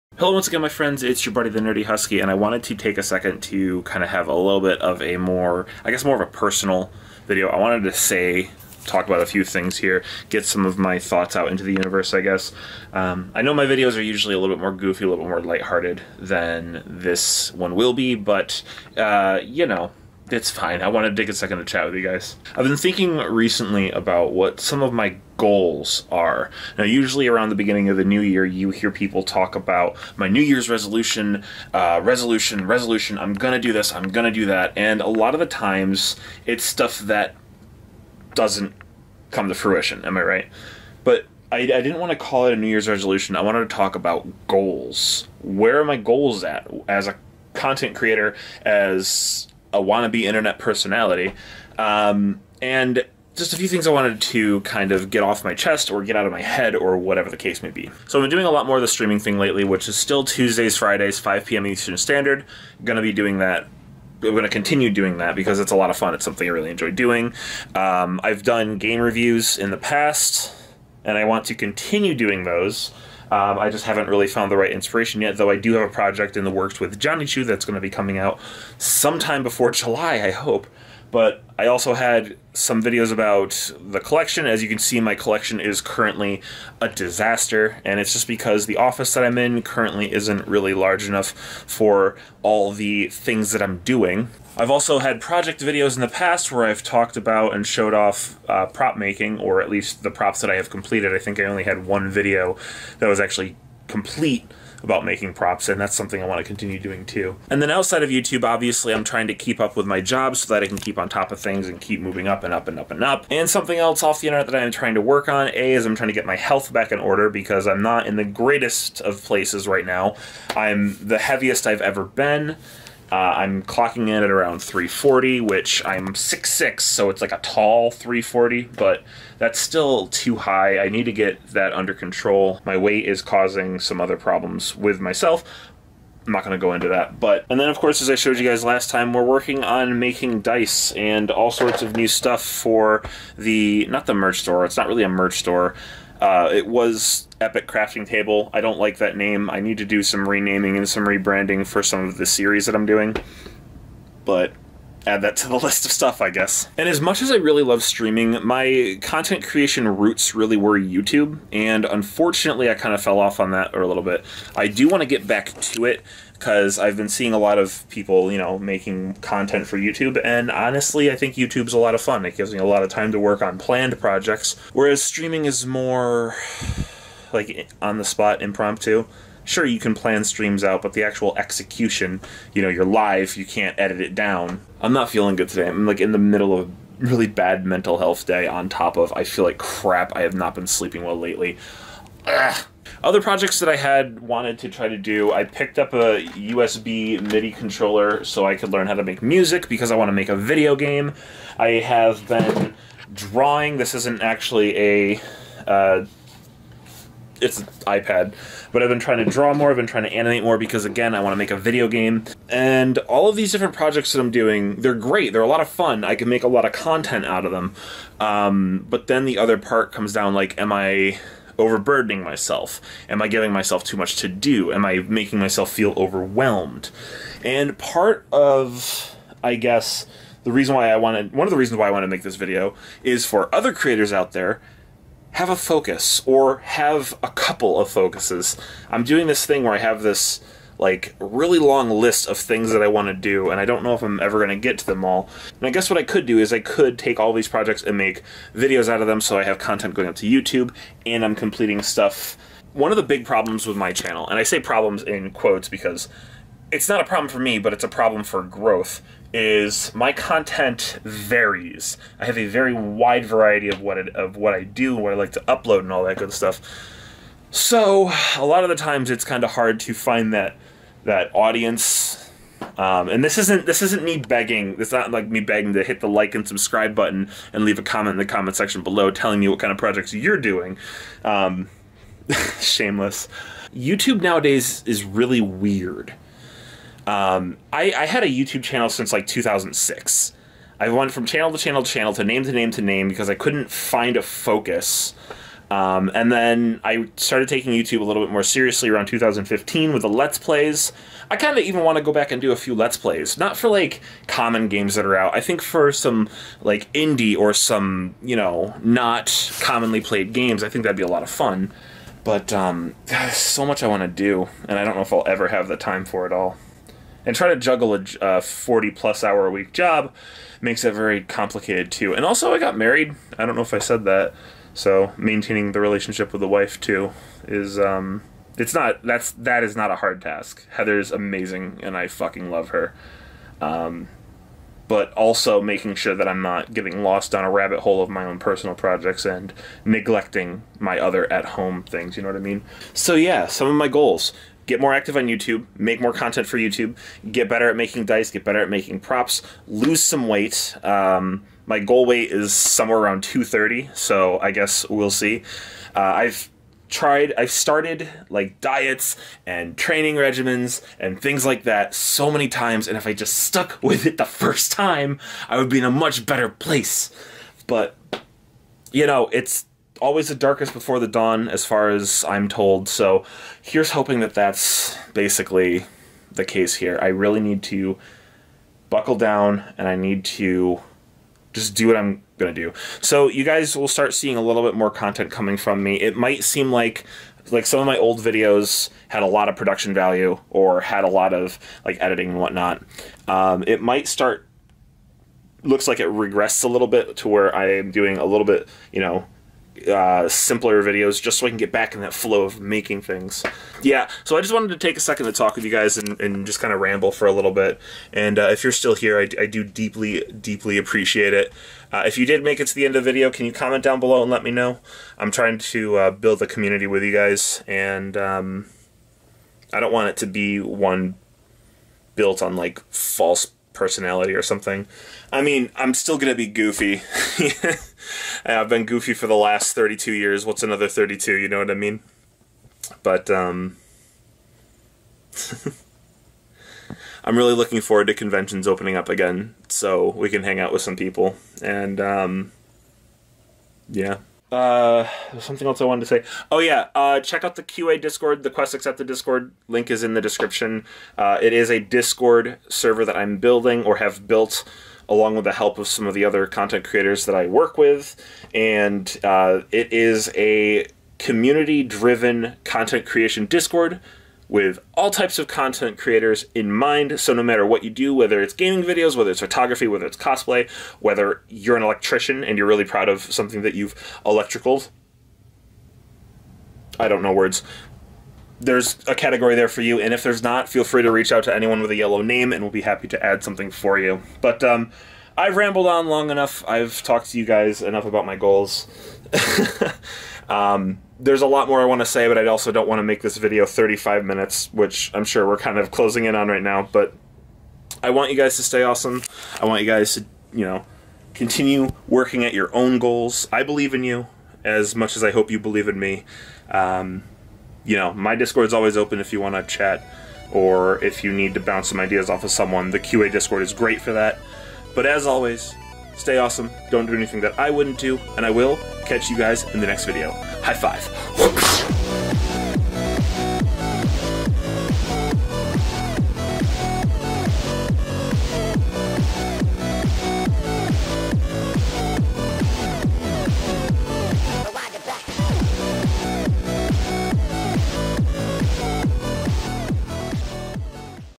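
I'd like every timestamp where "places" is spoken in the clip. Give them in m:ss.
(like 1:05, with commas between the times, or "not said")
1:59, 6:06.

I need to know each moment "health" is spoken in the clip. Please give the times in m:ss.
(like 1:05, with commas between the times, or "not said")
1:56, 3:07.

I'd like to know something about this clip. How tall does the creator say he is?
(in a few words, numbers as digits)
6'6".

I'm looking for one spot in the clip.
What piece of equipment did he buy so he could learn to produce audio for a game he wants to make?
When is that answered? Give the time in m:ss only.
3:16.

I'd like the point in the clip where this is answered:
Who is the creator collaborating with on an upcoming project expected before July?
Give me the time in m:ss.
1:16.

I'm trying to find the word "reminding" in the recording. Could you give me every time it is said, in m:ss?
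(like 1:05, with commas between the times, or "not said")
not said.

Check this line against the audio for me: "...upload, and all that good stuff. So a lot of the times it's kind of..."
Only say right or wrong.
right.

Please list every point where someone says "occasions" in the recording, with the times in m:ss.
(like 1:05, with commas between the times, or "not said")
not said.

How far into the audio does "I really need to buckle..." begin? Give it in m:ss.
6:17.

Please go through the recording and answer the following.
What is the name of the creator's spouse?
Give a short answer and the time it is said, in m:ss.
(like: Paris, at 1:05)
Heather, at 5:30.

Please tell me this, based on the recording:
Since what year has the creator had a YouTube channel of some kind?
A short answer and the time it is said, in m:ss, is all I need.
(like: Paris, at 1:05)
2006, at 4:49.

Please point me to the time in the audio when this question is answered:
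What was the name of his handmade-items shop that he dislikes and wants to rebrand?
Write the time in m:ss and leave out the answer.
2:27.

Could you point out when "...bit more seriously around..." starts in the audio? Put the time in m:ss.
4:58.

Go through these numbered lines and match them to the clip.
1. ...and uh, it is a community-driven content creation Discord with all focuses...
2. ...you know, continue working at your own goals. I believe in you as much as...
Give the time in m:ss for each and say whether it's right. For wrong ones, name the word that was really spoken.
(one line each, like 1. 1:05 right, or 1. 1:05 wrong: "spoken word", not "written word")
1. 7:38 wrong: "types", not "focuses"
2. 8:20 right.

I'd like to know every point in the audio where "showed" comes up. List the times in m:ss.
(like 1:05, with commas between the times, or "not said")
1:37, 2:18.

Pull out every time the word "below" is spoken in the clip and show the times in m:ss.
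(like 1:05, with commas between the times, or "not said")
4:38, 6:53.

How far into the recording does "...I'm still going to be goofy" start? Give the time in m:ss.
7:05.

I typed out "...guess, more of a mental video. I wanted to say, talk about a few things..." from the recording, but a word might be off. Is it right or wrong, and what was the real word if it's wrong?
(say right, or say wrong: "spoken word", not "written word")
wrong: "personal", not "mental".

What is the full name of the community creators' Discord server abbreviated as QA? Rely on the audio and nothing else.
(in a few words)
Quest Accepted.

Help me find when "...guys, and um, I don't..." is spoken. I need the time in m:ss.
6:57.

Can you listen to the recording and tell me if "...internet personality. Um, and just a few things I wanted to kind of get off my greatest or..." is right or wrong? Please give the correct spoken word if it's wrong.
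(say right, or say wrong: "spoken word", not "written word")
wrong: "chest", not "greatest".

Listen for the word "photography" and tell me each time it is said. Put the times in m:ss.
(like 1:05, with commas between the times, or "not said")
7:49.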